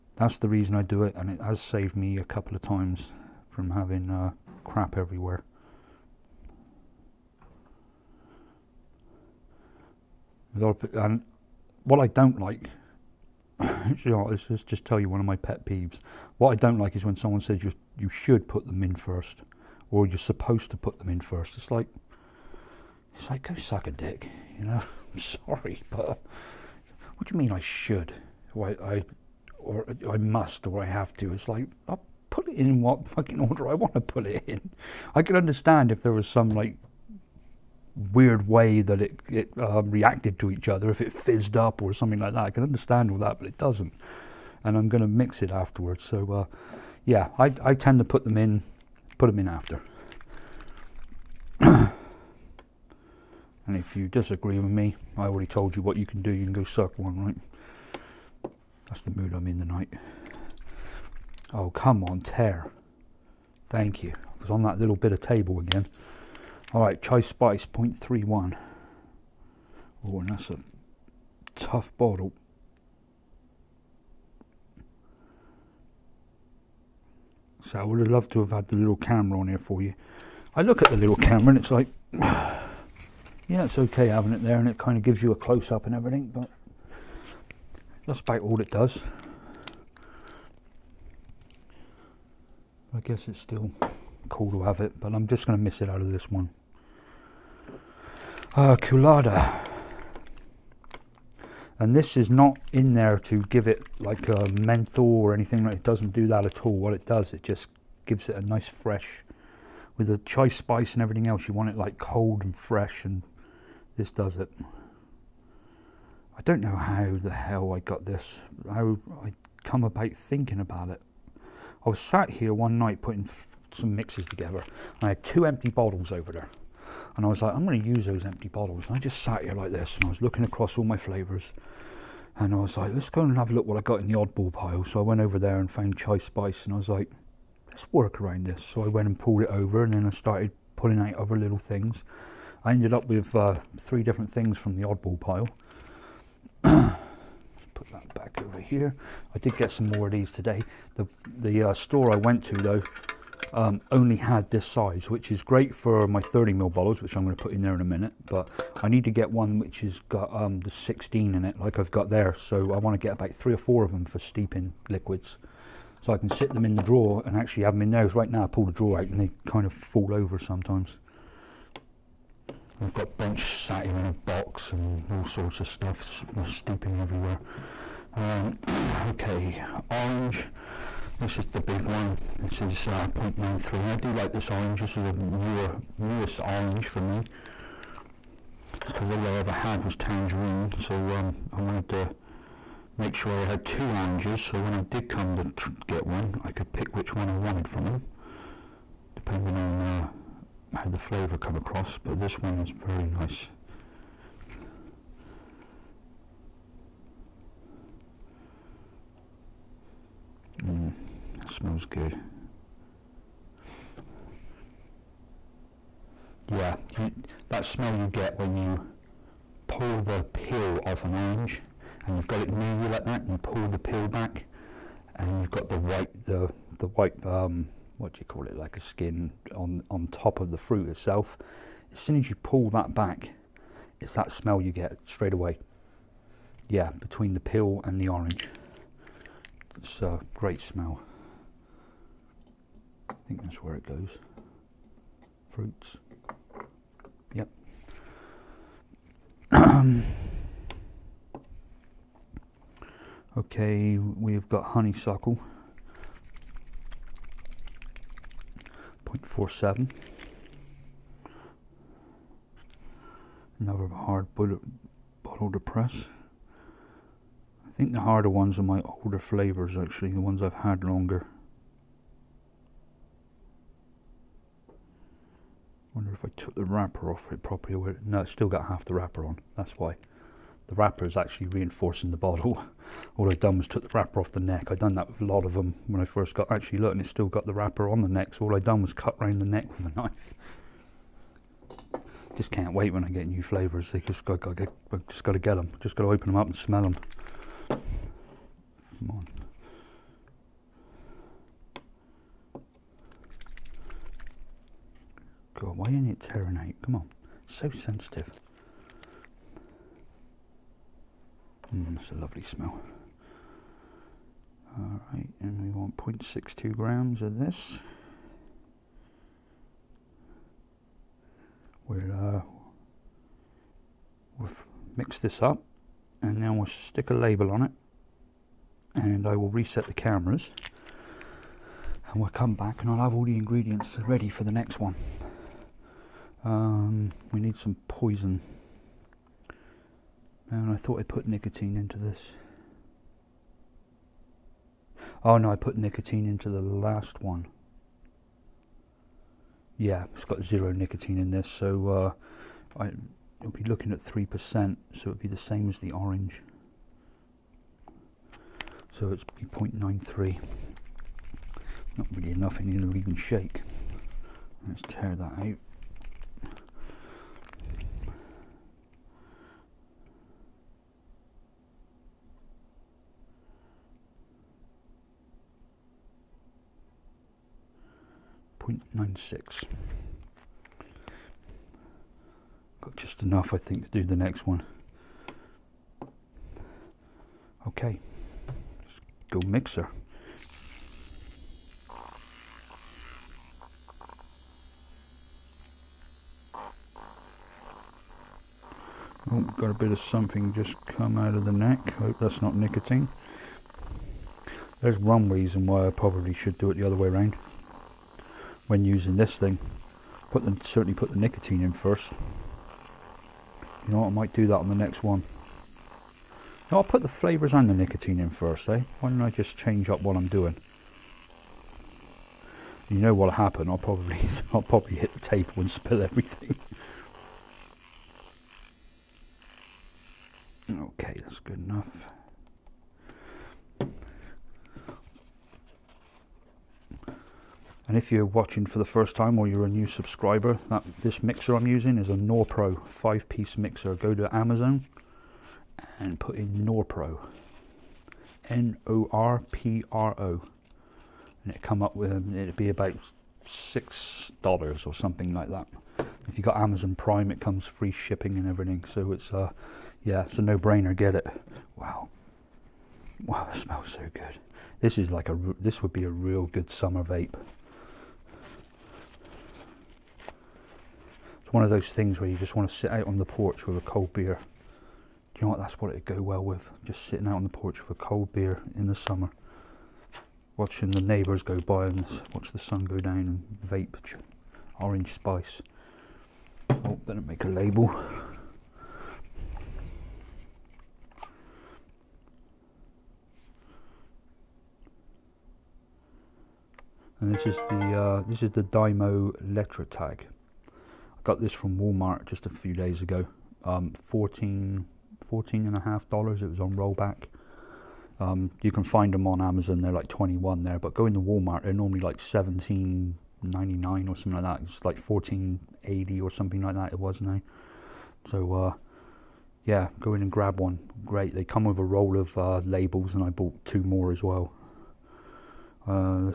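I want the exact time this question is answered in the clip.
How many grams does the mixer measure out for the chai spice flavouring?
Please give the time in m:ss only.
1:07.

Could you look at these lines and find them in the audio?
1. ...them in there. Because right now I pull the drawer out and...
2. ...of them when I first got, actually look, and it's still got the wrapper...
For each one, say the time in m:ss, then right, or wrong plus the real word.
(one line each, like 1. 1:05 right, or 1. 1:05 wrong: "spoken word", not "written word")
1. 2:47 right
2. 4:45 right.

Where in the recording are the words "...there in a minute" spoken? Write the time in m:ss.
2:37.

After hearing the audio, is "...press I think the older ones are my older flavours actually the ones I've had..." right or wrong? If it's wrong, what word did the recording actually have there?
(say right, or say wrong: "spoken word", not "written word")
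wrong: "harder", not "older".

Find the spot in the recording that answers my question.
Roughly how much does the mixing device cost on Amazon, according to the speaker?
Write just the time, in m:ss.
7:33.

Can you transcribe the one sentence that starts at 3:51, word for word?
As soon as you pull that back, it's that smell you get straight away.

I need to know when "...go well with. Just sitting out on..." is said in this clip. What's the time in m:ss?
7:56.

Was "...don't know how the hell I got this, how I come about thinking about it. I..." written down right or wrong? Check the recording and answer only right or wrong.
right.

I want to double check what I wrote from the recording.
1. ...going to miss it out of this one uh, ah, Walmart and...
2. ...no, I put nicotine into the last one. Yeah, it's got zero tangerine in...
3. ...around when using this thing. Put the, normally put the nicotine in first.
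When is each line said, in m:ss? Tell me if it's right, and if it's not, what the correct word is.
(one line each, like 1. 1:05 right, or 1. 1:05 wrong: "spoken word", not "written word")
1. 1:35 wrong: "Koolada", not "Walmart"
2. 5:45 wrong: "nicotine", not "tangerine"
3. 6:47 wrong: "certainly", not "normally".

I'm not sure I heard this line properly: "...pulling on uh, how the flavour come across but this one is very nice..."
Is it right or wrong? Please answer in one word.
wrong.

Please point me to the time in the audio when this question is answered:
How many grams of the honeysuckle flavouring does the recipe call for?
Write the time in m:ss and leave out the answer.
5:15.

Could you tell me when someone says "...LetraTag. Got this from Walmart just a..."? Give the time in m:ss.
8:19.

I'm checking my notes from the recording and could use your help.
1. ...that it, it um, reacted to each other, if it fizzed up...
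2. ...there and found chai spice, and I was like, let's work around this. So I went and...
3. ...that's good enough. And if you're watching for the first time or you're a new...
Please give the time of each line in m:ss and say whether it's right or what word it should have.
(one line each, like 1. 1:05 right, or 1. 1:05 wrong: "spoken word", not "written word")
1. 0:38 right
2. 2:15 right
3. 7:11 right.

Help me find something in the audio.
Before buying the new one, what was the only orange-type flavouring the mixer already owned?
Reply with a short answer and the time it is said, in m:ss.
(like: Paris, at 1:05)
Tangerine, at 3:09.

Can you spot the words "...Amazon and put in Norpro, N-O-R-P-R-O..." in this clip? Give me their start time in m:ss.
7:24.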